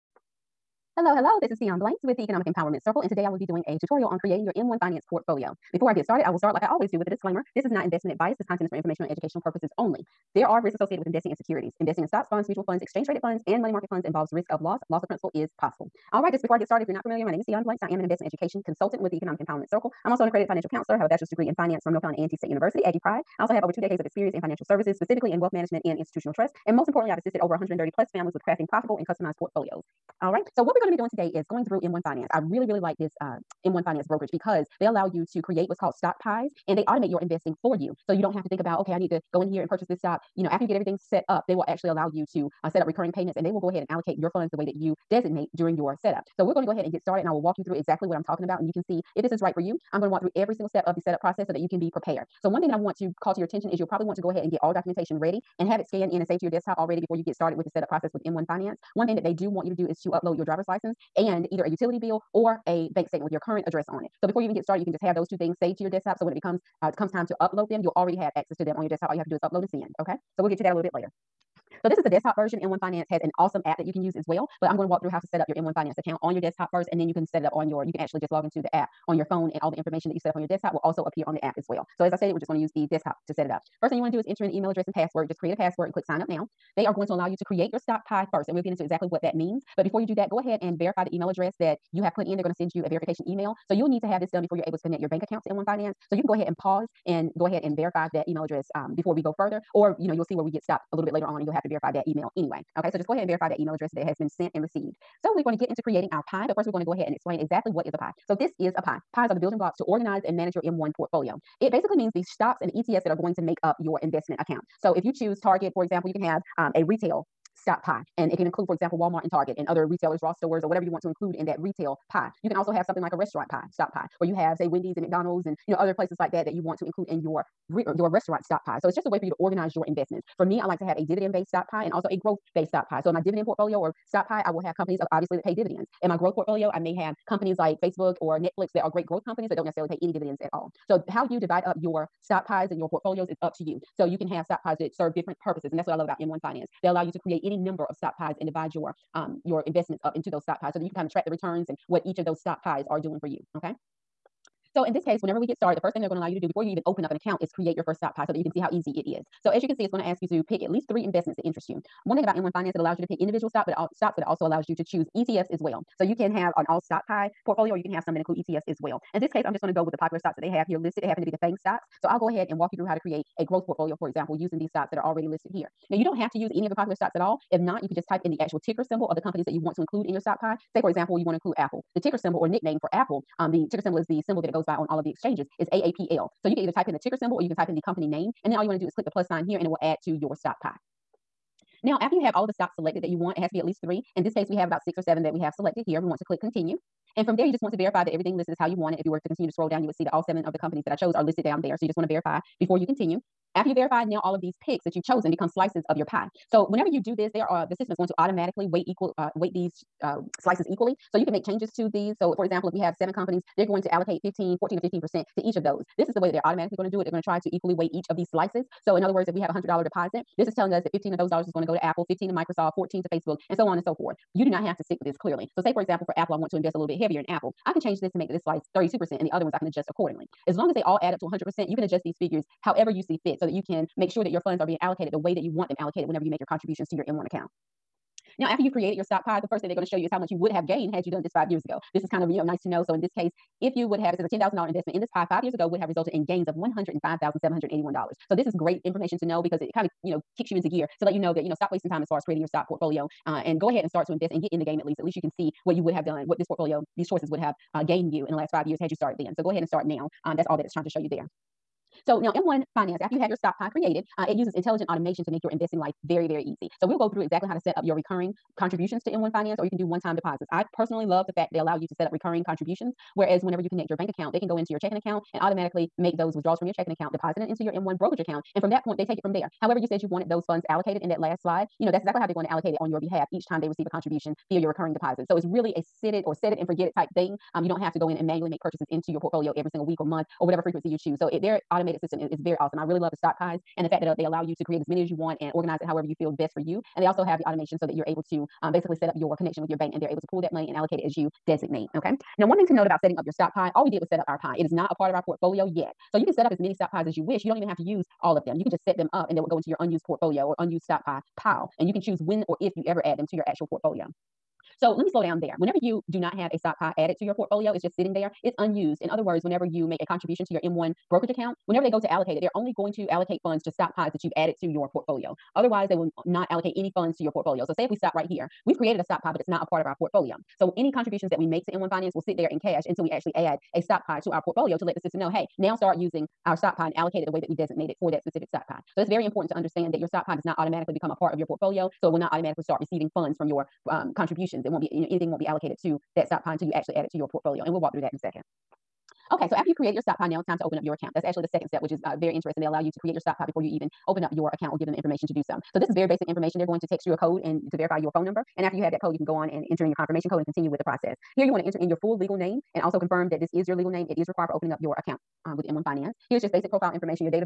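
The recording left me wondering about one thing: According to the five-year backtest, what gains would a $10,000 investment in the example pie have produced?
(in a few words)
$105,781.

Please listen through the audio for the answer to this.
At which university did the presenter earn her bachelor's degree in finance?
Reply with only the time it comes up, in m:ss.
0:21.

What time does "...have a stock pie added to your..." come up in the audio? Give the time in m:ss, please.
5:16.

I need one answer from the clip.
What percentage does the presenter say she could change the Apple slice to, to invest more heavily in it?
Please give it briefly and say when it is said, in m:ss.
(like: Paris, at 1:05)
32%, at 3:48.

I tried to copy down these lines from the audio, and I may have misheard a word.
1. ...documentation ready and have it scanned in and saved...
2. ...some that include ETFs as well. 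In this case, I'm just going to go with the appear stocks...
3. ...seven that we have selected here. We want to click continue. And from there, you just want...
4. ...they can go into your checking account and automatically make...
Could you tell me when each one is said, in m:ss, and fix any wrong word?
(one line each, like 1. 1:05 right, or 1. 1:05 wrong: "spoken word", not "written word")
1. 0:54 right
2. 2:48 wrong: "popular", not "appear"
3. 3:15 right
4. 4:34 right.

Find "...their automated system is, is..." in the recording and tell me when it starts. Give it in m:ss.
4:51.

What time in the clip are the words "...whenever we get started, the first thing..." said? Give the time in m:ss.
2:35.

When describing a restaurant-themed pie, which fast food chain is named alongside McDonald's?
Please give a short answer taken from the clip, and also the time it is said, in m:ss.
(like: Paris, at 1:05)
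Wendy's, at 2:04.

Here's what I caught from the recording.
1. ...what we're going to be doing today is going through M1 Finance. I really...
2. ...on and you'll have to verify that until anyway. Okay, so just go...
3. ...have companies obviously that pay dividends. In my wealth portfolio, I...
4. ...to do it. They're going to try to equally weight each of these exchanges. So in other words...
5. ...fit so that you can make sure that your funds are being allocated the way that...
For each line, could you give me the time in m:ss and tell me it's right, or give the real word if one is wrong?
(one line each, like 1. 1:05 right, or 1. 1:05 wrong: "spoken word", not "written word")
1. 0:30 right
2. 1:41 wrong: "email", not "until"
3. 2:14 wrong: "growth", not "wealth"
4. 3:36 wrong: "slices", not "exchanges"
5. 3:53 right.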